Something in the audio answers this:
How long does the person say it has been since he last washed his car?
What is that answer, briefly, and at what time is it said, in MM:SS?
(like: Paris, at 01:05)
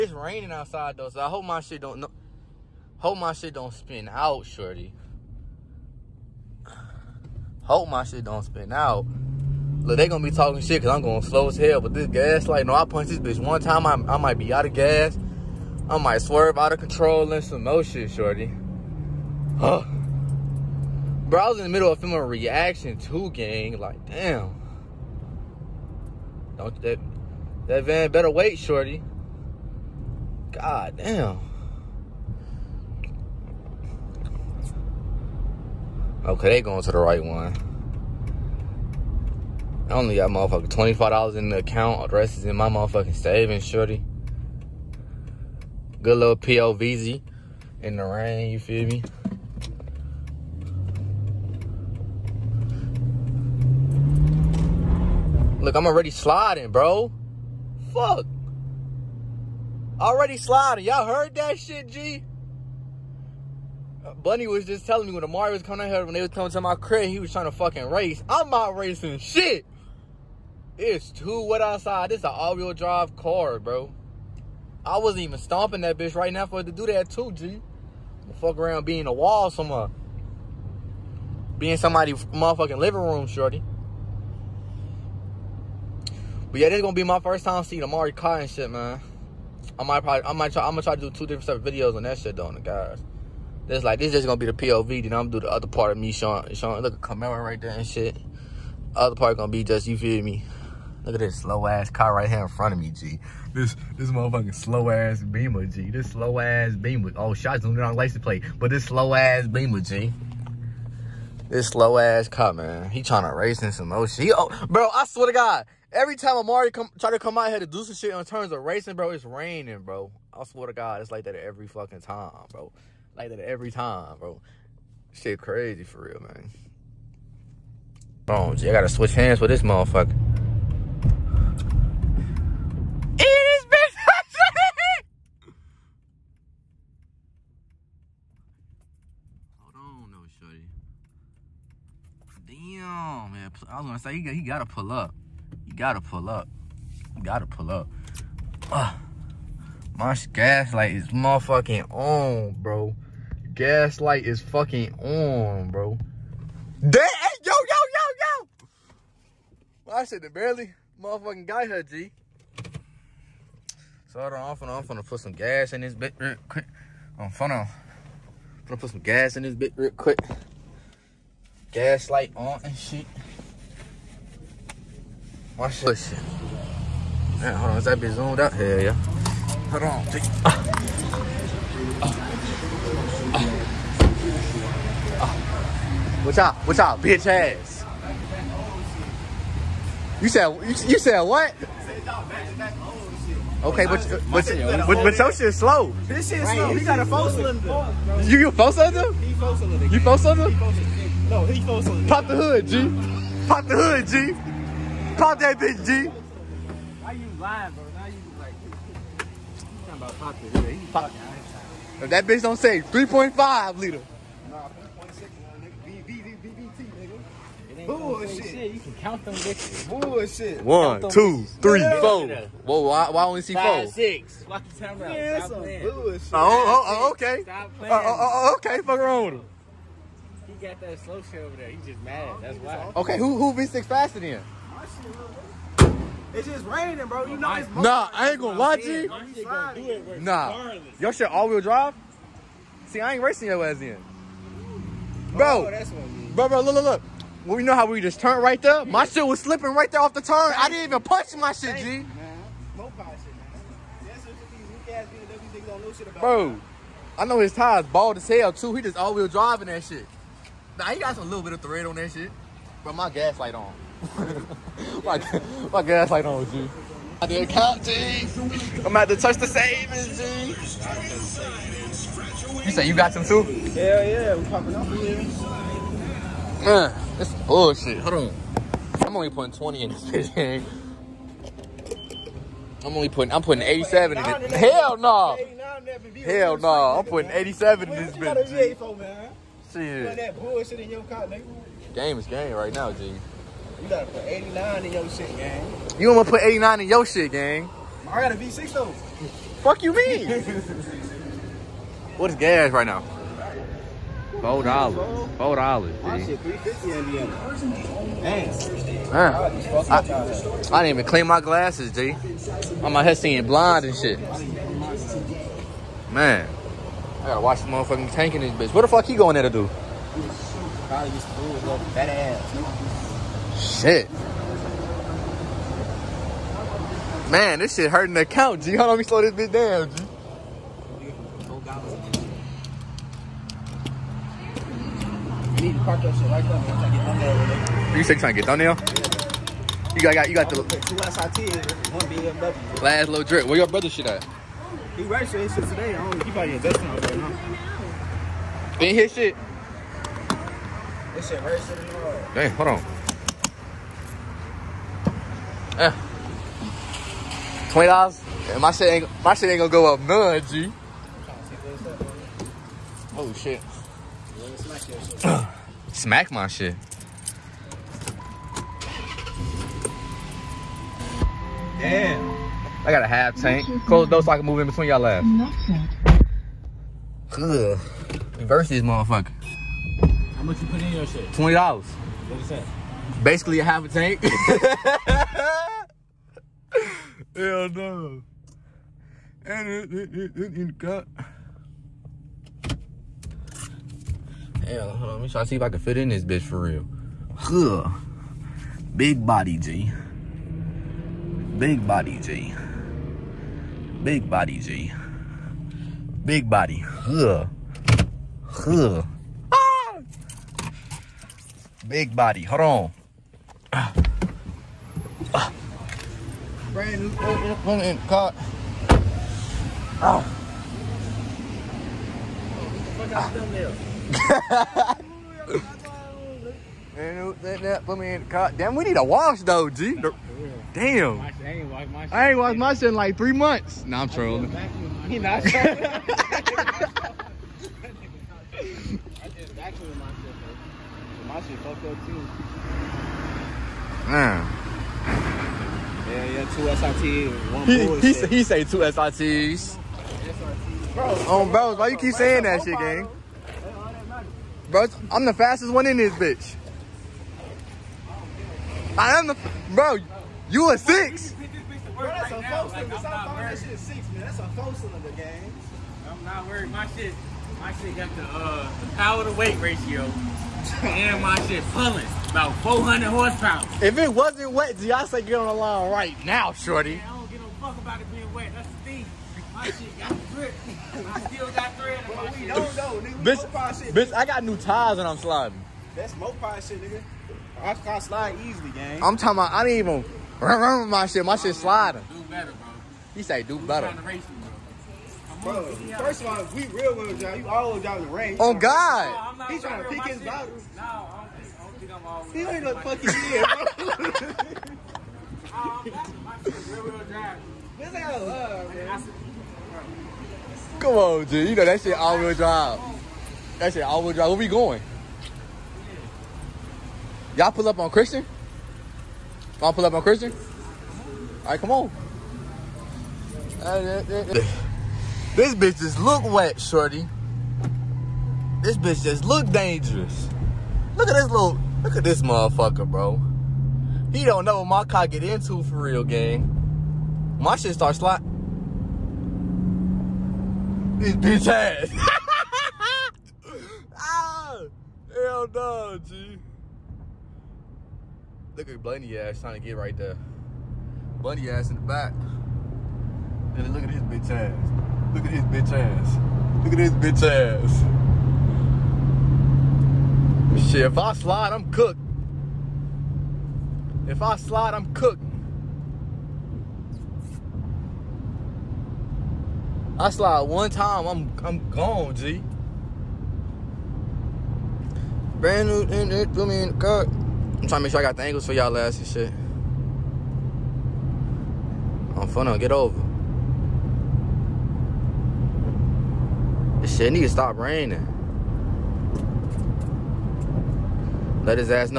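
three months, at 07:13.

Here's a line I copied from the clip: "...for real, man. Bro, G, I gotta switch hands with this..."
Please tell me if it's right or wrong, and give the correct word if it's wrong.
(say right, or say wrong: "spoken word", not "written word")
right.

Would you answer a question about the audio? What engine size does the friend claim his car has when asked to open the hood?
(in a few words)
3.6 liter.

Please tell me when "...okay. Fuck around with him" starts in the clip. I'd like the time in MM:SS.
03:48.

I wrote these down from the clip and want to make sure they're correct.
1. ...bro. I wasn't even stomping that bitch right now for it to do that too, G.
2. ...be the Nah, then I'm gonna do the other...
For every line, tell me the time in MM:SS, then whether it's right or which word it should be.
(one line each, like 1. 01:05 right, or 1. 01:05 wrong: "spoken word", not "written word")
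1. 01:13 right
2. 01:34 wrong: "POV", not "Nah".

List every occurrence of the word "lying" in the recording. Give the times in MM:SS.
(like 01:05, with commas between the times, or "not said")
03:27.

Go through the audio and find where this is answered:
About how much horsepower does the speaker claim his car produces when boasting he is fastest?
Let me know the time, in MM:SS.
07:52.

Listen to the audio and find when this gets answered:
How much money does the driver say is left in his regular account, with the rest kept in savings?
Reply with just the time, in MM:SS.
00:40.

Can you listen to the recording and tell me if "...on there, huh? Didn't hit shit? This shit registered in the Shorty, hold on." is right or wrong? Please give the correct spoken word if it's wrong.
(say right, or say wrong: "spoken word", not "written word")
wrong: "Hey", not "Shorty".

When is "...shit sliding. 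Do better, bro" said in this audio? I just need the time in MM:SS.
08:11.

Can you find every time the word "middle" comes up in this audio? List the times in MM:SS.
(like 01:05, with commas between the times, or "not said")
00:21.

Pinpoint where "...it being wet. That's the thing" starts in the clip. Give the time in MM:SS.
07:57.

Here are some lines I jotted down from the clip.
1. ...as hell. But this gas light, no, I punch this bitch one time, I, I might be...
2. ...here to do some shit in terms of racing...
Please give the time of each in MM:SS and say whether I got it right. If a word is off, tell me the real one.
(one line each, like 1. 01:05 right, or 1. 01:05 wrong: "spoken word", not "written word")
1. 00:11 right
2. 01:57 right.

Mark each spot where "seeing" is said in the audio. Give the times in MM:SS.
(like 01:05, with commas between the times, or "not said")
01:27, 05:13.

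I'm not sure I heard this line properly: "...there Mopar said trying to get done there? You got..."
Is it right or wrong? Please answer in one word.
wrong.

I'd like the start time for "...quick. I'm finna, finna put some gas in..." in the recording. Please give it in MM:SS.
02:46.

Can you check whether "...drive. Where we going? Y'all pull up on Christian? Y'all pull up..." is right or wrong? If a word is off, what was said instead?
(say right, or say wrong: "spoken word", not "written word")
right.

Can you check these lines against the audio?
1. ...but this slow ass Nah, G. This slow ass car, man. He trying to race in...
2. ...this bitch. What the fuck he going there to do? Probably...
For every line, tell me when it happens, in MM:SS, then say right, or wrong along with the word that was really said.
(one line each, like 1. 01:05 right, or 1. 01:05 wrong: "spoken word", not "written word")
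1. 01:48 wrong: "Beamer", not "Nah"
2. 05:18 right.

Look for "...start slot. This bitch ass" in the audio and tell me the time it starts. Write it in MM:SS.
08:57.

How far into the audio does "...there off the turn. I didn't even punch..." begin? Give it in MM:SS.
04:09.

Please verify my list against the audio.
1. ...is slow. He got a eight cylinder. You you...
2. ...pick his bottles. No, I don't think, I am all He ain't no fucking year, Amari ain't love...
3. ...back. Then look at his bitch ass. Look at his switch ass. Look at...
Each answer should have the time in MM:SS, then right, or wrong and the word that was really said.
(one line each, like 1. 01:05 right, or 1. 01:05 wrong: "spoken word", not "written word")
1. 03:16 wrong: "four", not "eight"
2. 08:19 wrong: "This", not "Amari"
3. 09:11 wrong: "bitch", not "switch".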